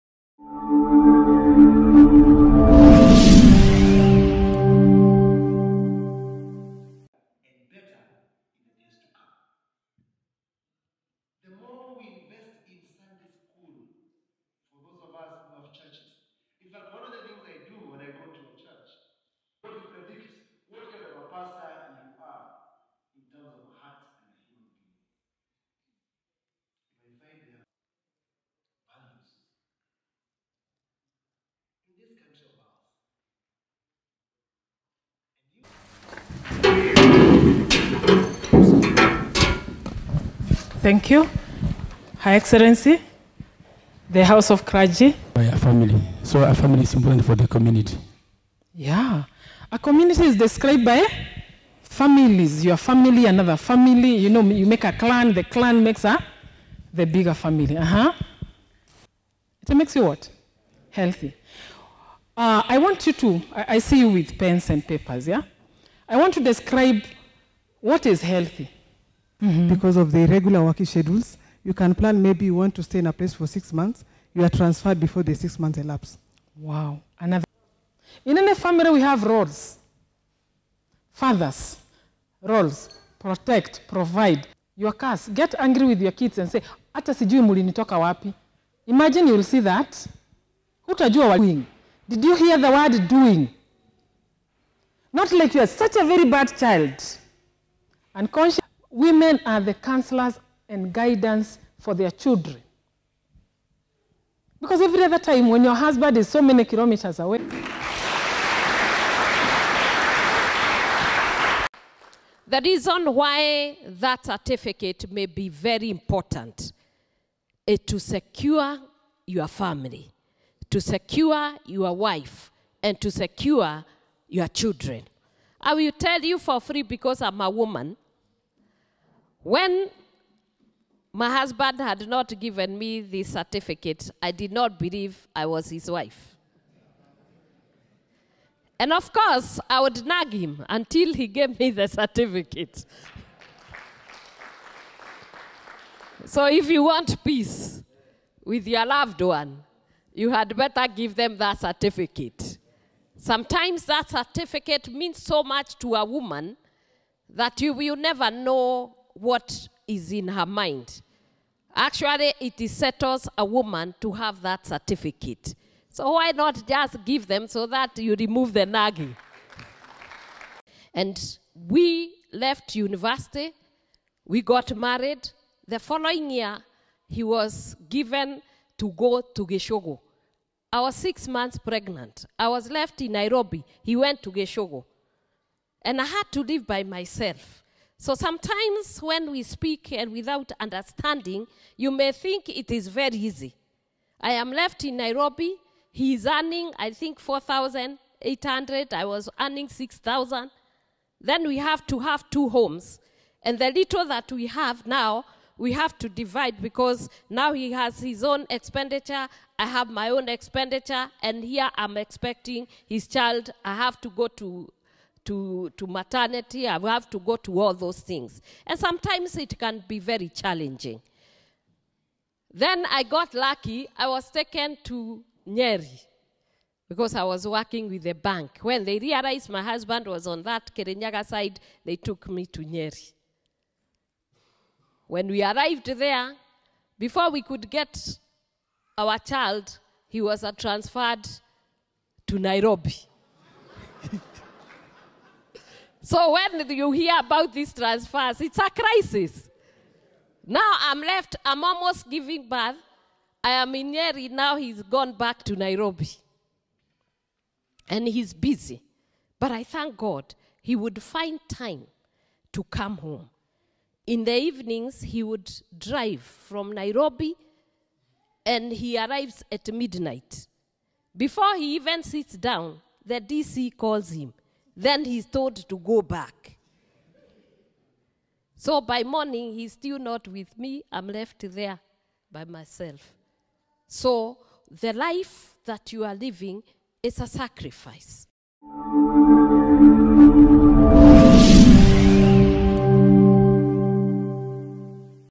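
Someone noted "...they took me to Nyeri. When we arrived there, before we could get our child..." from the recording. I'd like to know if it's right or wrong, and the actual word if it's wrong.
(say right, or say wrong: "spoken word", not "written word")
right.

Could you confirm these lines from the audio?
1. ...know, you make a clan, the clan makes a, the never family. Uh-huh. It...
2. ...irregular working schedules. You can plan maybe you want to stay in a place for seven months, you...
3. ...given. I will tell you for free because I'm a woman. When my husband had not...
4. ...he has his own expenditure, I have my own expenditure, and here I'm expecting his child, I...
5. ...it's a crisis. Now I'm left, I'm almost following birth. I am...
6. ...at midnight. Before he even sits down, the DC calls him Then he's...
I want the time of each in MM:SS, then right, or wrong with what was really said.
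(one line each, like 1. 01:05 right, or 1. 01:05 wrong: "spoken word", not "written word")
1. 00:54 wrong: "bigger", not "never"
2. 01:10 wrong: "six", not "seven"
3. 02:04 wrong: "children", not "given"
4. 03:27 right
5. 04:08 wrong: "giving", not "following"
6. 04:29 right.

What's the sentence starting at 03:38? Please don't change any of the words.
And sometimes it can be very challenging.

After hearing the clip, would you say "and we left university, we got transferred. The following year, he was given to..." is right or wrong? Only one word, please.
wrong.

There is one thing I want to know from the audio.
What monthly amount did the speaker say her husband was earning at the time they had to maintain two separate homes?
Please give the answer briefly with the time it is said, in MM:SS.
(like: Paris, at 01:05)
4,800, at 03:17.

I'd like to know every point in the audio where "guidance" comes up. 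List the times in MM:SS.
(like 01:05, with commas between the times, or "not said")
01:40.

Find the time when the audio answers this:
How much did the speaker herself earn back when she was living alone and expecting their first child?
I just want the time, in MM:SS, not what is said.
03:19.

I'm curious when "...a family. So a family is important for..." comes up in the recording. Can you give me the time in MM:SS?
00:45.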